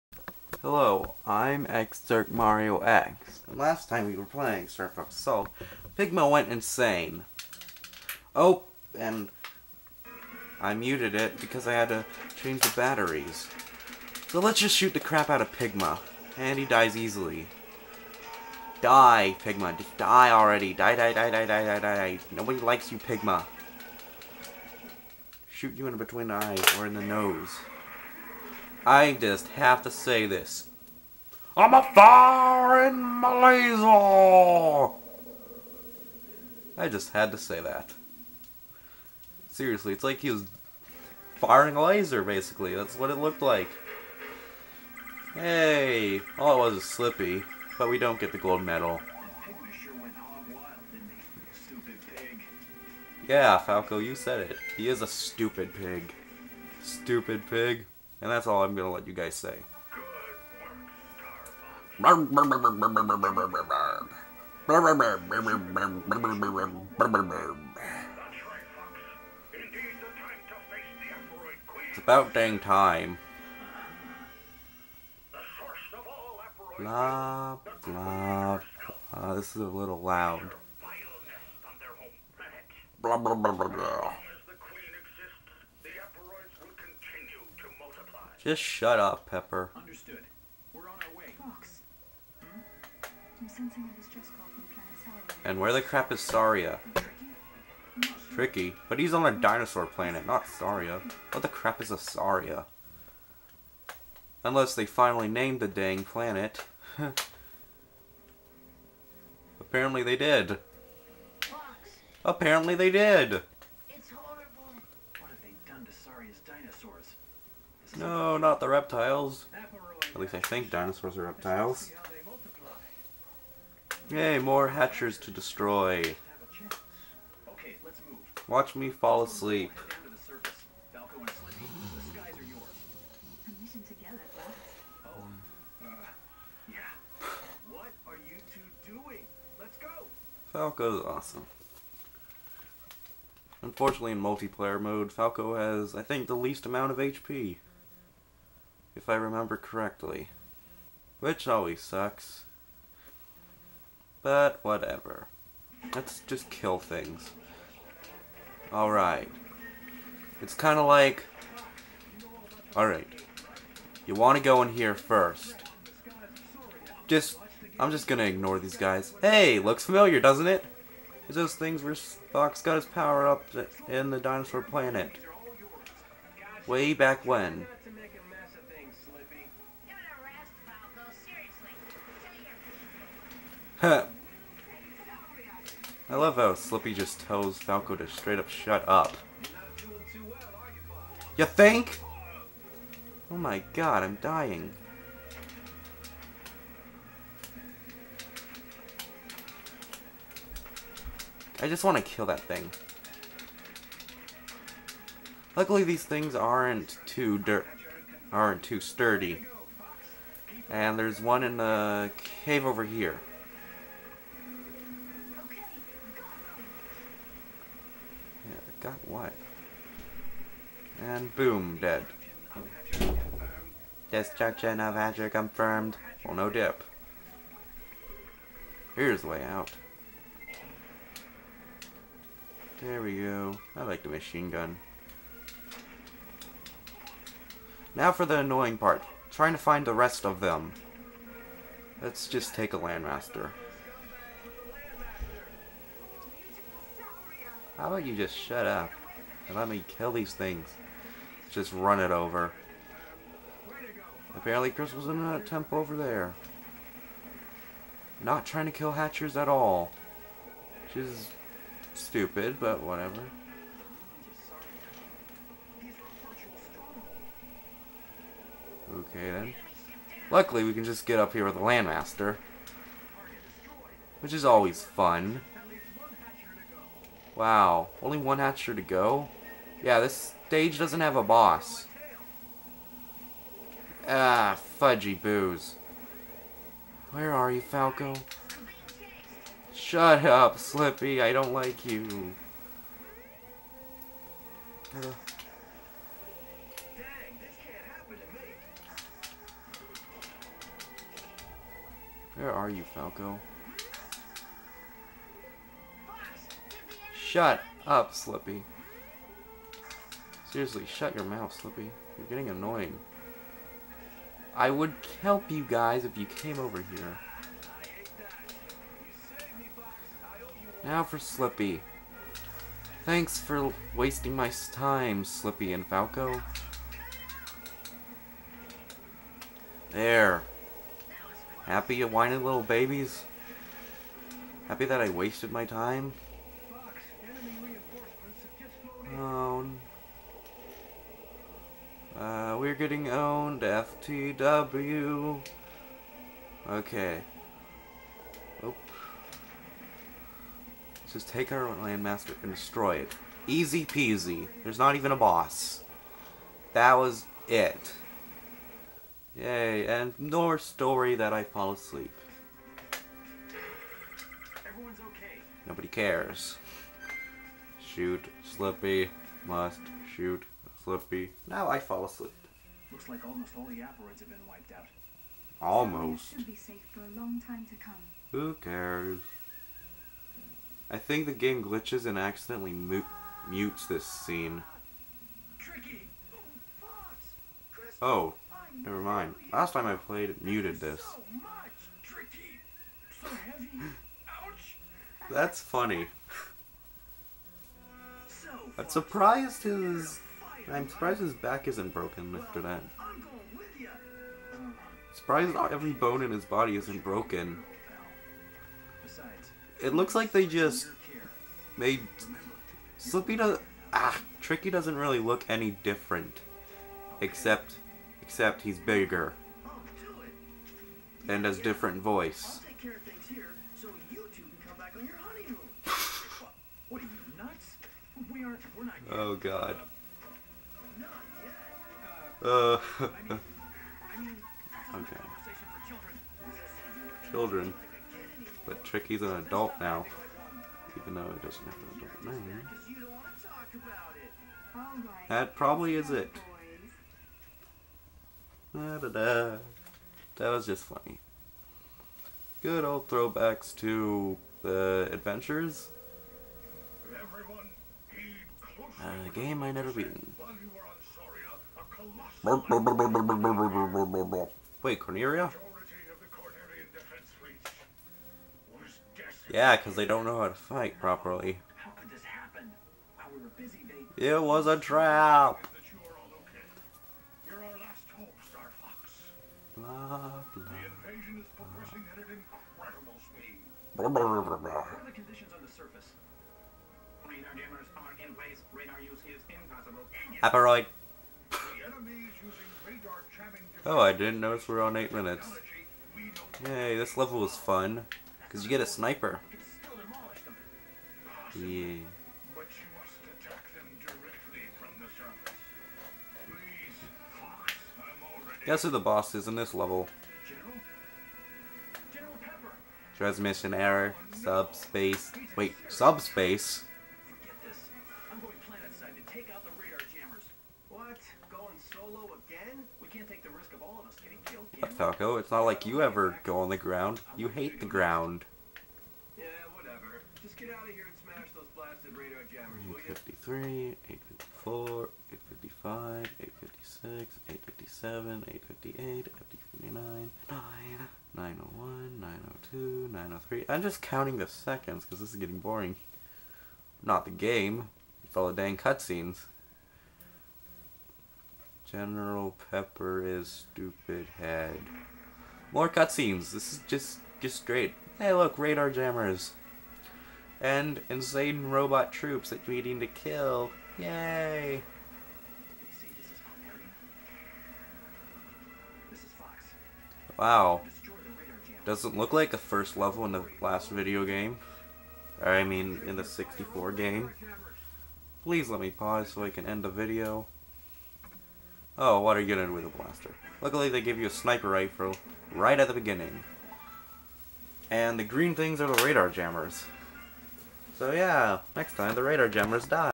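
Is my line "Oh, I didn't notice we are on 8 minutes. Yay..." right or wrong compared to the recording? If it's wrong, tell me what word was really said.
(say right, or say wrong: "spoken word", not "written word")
right.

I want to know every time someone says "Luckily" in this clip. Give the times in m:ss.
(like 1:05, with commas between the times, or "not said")
3:25, 4:30, 9:43.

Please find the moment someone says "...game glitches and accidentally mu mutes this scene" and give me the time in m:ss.
6:21.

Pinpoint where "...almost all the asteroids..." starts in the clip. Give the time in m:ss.
6:13.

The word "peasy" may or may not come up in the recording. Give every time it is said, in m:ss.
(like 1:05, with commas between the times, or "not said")
5:53.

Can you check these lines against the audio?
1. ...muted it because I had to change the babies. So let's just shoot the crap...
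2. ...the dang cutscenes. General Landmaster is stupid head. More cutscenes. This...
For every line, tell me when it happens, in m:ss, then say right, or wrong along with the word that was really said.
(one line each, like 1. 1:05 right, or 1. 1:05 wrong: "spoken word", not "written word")
1. 0:10 wrong: "batteries", not "babies"
2. 9:08 wrong: "Pepper", not "Landmaster".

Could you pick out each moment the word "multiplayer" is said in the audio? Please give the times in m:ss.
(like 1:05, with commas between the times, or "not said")
2:24.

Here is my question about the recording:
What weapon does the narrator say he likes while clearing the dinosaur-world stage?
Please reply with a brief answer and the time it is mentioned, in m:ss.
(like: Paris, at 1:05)
Machine gun, at 3:54.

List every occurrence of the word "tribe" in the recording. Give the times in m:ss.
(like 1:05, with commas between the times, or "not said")
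not said.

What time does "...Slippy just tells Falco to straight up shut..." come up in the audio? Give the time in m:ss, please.
3:06.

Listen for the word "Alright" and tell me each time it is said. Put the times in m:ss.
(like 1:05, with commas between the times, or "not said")
2:38, 2:42.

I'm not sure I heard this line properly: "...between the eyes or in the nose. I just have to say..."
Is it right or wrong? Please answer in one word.
right.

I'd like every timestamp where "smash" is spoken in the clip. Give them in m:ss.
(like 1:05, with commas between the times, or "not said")
8:51.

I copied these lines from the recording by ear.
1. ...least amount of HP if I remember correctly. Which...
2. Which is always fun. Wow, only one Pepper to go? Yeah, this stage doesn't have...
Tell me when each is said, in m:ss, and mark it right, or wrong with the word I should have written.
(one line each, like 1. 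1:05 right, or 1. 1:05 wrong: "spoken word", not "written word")
1. 2:26 right
2. 4:34 wrong: "Hatcher", not "Pepper".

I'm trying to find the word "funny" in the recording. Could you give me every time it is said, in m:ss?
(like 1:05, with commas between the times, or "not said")
6:35, 7:30.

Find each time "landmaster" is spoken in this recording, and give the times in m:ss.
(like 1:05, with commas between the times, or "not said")
4:02, 4:31, 5:51.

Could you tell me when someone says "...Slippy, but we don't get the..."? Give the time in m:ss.
0:46.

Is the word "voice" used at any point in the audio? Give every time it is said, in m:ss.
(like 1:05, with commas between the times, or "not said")
7:02.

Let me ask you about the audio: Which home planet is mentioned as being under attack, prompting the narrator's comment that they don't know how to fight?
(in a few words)
Corneria.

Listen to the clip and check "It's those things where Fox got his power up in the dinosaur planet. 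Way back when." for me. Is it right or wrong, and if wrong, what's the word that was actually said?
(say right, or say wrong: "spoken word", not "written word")
right.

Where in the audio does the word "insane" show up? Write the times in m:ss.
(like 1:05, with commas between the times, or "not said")
0:06, 9:21.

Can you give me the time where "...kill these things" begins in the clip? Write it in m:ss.
4:09.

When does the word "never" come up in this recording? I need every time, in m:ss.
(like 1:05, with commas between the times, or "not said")
6:28, 7:39.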